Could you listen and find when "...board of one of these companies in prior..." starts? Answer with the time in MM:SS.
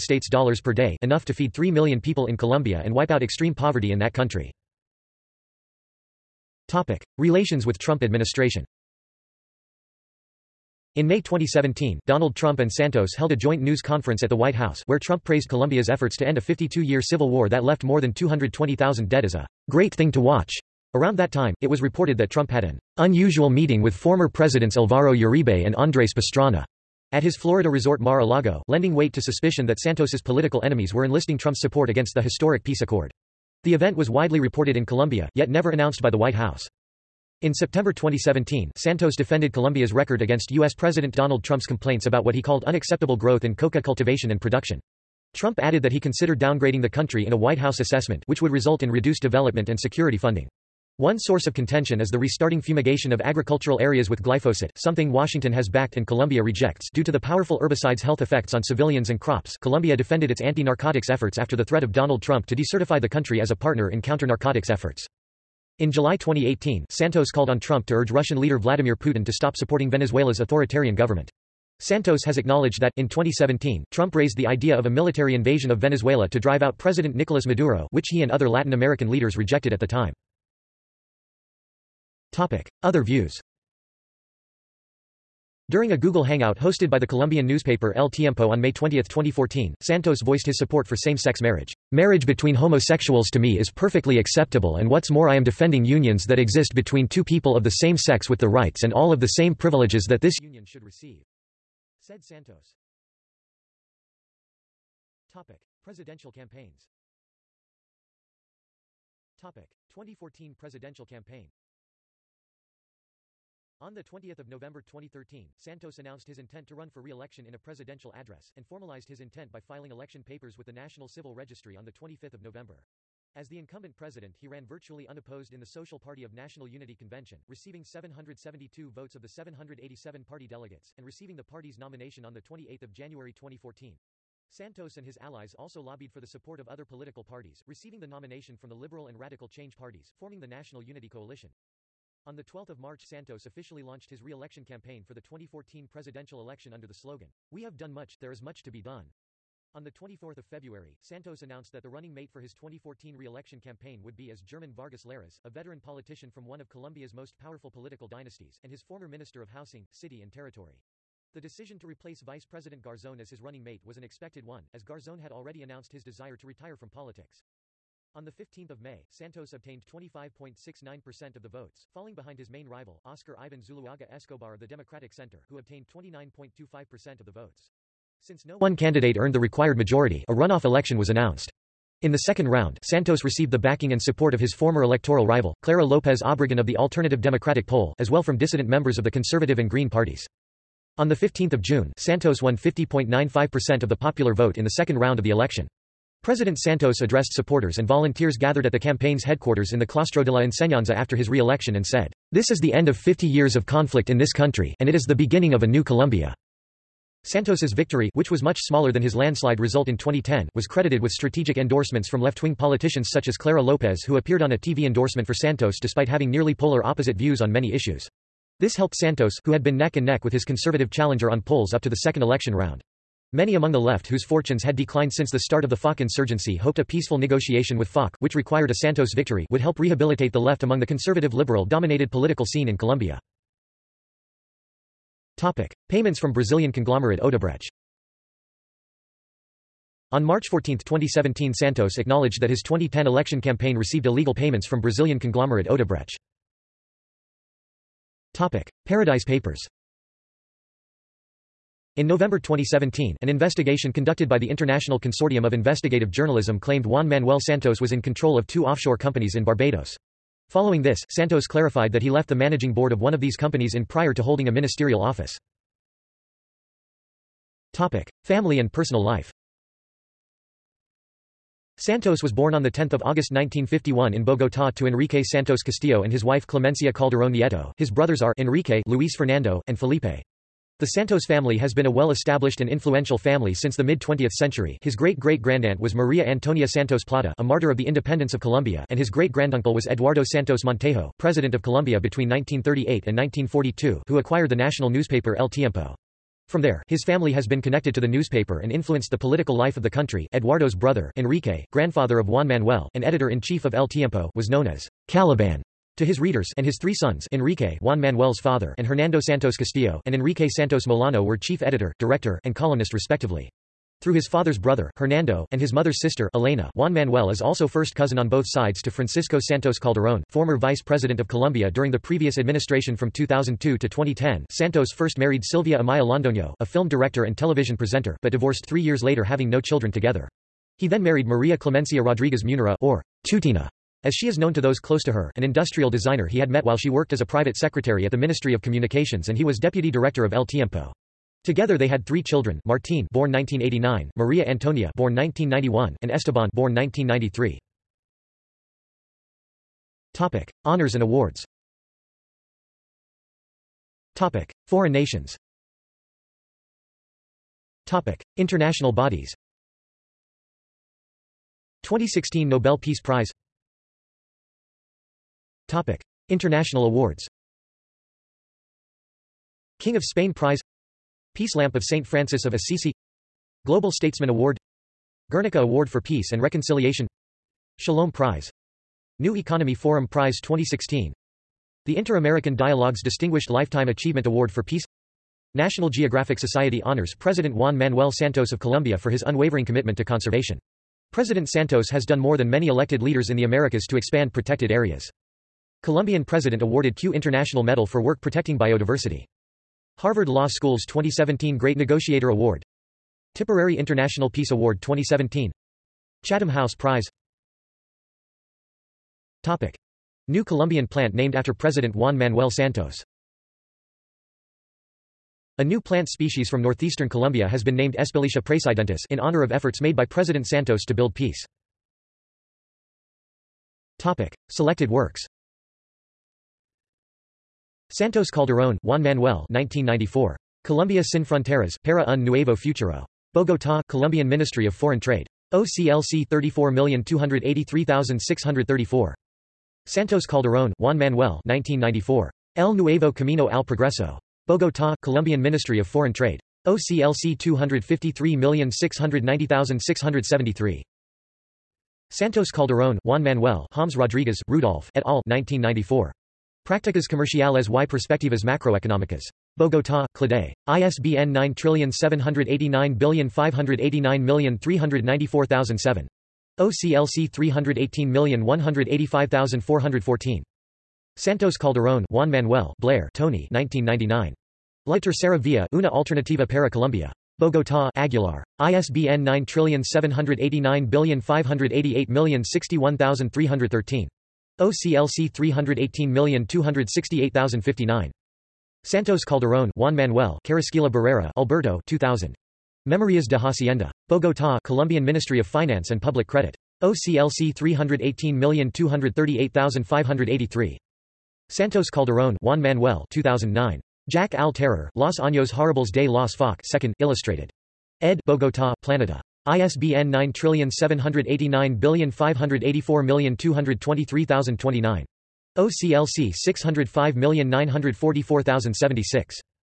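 04:22.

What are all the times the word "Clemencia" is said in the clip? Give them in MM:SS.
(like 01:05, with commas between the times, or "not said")
04:36, 05:31.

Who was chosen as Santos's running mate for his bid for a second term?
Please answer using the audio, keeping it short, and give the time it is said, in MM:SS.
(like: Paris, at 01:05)
German Vargas Lleras, at 02:34.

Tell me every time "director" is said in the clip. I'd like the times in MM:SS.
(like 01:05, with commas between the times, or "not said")
05:11, 05:26, 05:39.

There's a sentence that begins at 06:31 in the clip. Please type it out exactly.
President Santos has done more than many elected leaders in the Americas to expand protected areas.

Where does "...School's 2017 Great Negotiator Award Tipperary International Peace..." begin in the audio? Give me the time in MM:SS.
06:40.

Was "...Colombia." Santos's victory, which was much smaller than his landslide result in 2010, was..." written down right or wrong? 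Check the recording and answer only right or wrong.
right.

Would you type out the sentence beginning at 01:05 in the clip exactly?
In July 2018, Santos called on Trump to urge Russian leader Vladimir Putin to stop supporting Venezuela's authoritarian government.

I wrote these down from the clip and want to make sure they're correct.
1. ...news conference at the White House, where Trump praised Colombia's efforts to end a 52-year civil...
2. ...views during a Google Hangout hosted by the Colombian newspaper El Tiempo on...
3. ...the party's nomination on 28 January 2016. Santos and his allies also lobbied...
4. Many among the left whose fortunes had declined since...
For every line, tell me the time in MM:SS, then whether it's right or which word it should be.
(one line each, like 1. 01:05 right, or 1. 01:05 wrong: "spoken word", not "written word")
1. 00:13 right
2. 01:23 right
3. 02:11 wrong: "2014", not "2016"
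4. 03:43 right.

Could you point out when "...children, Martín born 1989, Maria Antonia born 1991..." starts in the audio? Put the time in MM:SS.
05:42.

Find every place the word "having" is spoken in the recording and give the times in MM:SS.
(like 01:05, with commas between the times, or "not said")
03:36, 05:29.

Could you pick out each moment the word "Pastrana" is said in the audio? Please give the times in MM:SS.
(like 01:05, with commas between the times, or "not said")
00:26.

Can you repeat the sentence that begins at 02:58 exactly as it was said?
Since no one candidate earned the required majority, a runoff election was announced.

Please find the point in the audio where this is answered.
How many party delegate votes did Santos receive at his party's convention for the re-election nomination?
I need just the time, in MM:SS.
02:07.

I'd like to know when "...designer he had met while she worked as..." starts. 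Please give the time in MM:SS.
05:35.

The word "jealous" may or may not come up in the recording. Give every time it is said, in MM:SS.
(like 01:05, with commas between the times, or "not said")
not said.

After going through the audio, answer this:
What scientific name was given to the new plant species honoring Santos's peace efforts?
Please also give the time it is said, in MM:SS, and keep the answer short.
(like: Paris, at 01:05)
Espeletia praesidentis, at 06:57.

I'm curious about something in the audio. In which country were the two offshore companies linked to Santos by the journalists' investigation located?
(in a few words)
Barbados.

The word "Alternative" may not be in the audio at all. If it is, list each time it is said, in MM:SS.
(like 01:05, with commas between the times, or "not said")
03:06.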